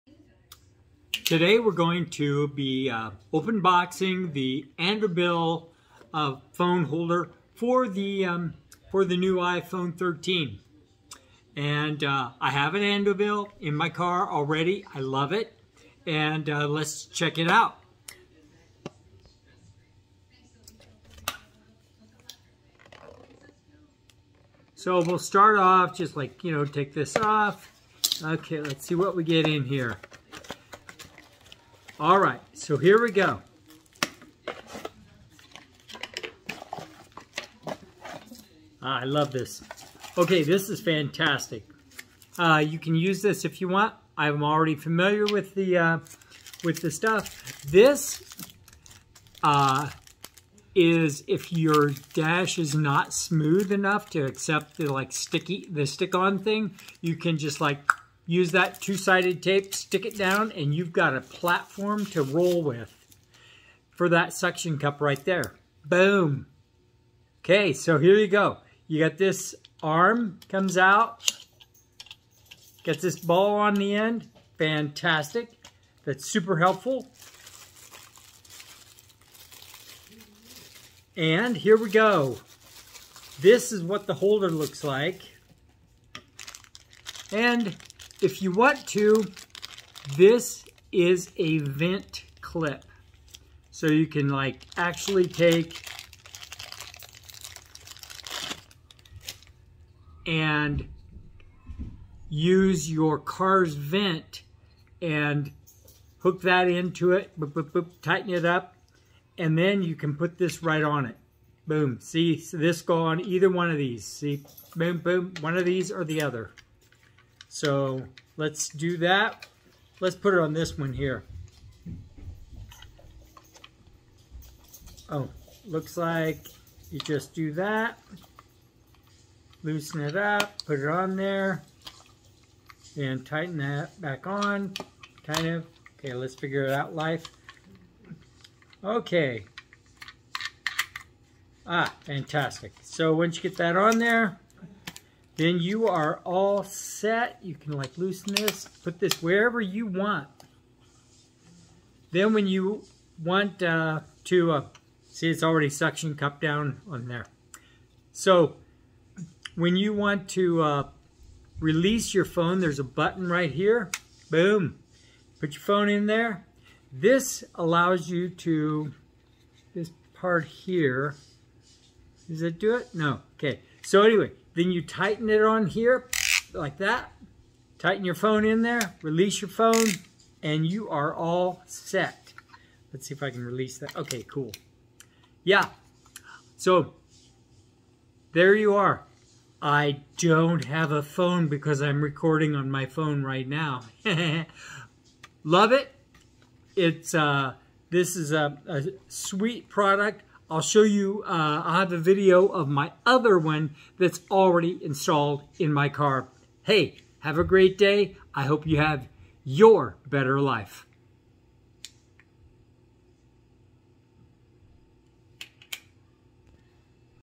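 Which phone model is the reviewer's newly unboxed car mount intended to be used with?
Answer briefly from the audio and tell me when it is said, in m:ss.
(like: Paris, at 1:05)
iPhone 13, at 0:09.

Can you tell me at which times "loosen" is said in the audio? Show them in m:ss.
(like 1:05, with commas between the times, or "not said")
2:09, 2:27.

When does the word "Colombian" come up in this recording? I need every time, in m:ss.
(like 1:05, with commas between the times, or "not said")
not said.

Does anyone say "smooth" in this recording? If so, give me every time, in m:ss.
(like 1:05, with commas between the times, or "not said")
0:53.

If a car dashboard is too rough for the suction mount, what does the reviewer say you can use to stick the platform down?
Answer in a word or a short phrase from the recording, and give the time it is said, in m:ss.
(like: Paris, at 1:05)
two-sided tape, at 0:58.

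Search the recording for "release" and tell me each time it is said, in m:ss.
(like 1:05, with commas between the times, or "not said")
2:41, 2:59, 3:03.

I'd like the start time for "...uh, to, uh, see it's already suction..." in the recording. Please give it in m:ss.
2:33.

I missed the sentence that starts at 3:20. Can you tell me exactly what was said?
I'll show you, uh, i have a video of my other one that's already installed in my car.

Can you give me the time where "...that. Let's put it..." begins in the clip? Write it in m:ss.
1:58.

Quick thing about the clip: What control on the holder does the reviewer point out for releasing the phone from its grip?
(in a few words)
a button.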